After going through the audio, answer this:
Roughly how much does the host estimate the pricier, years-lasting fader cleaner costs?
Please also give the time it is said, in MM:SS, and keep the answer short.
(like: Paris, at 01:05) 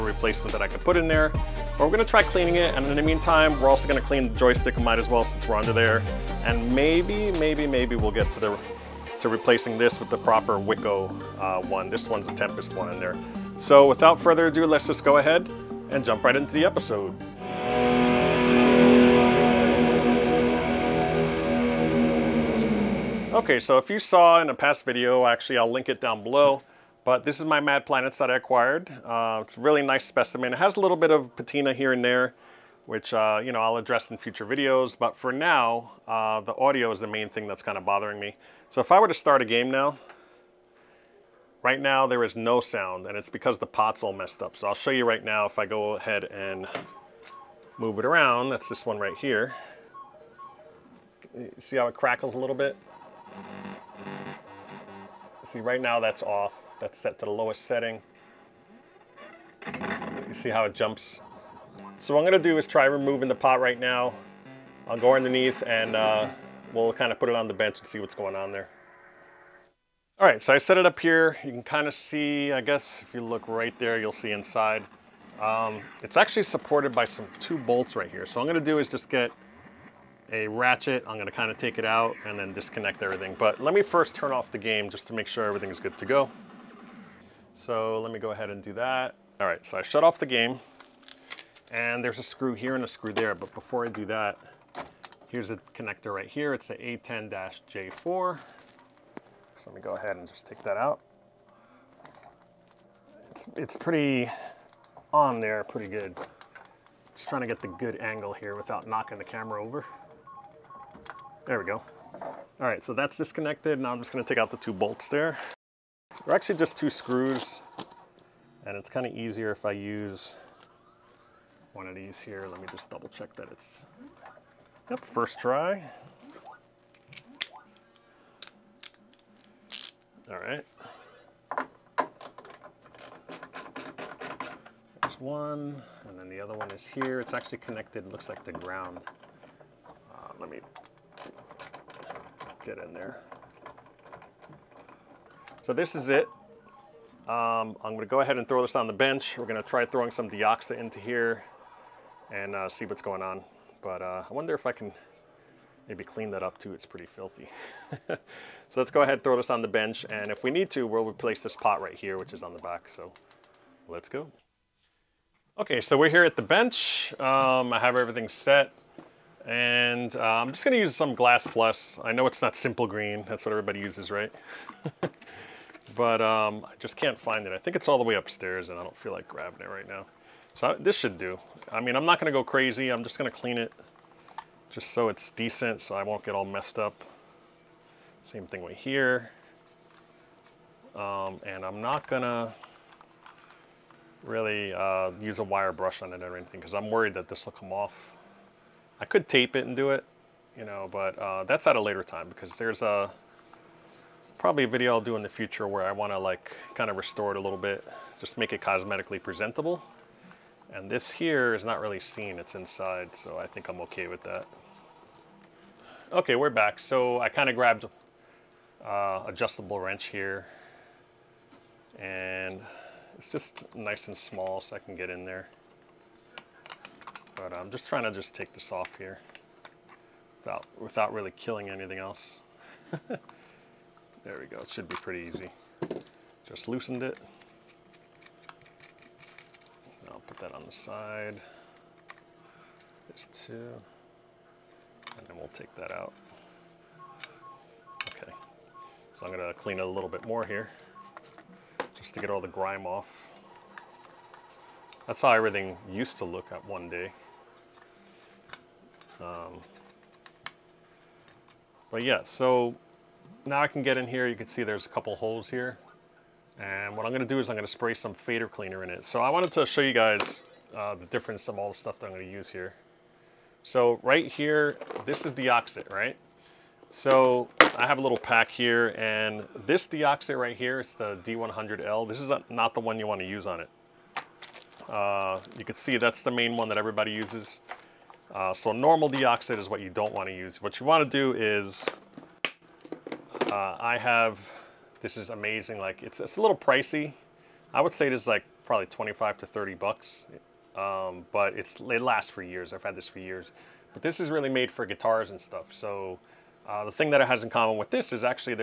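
25 to 30 dollars, at 04:58.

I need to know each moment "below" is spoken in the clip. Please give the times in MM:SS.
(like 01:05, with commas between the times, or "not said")
00:26.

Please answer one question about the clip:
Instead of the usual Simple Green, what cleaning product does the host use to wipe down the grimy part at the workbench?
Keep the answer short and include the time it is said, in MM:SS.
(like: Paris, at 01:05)
Glass Plus, at 02:51.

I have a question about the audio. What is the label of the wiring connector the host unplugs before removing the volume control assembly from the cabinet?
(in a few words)
A10-J4.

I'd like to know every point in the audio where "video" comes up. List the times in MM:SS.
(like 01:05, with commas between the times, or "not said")
00:24, 00:34, 03:24.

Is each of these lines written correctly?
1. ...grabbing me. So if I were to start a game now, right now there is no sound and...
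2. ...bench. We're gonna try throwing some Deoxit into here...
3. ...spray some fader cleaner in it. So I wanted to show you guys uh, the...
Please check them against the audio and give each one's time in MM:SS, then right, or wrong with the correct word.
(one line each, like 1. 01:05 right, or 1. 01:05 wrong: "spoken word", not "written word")
1. 00:37 wrong: "bothering", not "grabbing"
2. 02:28 right
3. 04:27 right.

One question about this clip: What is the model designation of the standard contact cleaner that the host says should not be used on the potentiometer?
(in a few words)
D100L.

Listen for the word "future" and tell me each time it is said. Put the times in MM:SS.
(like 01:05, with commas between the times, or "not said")
00:34, 03:25.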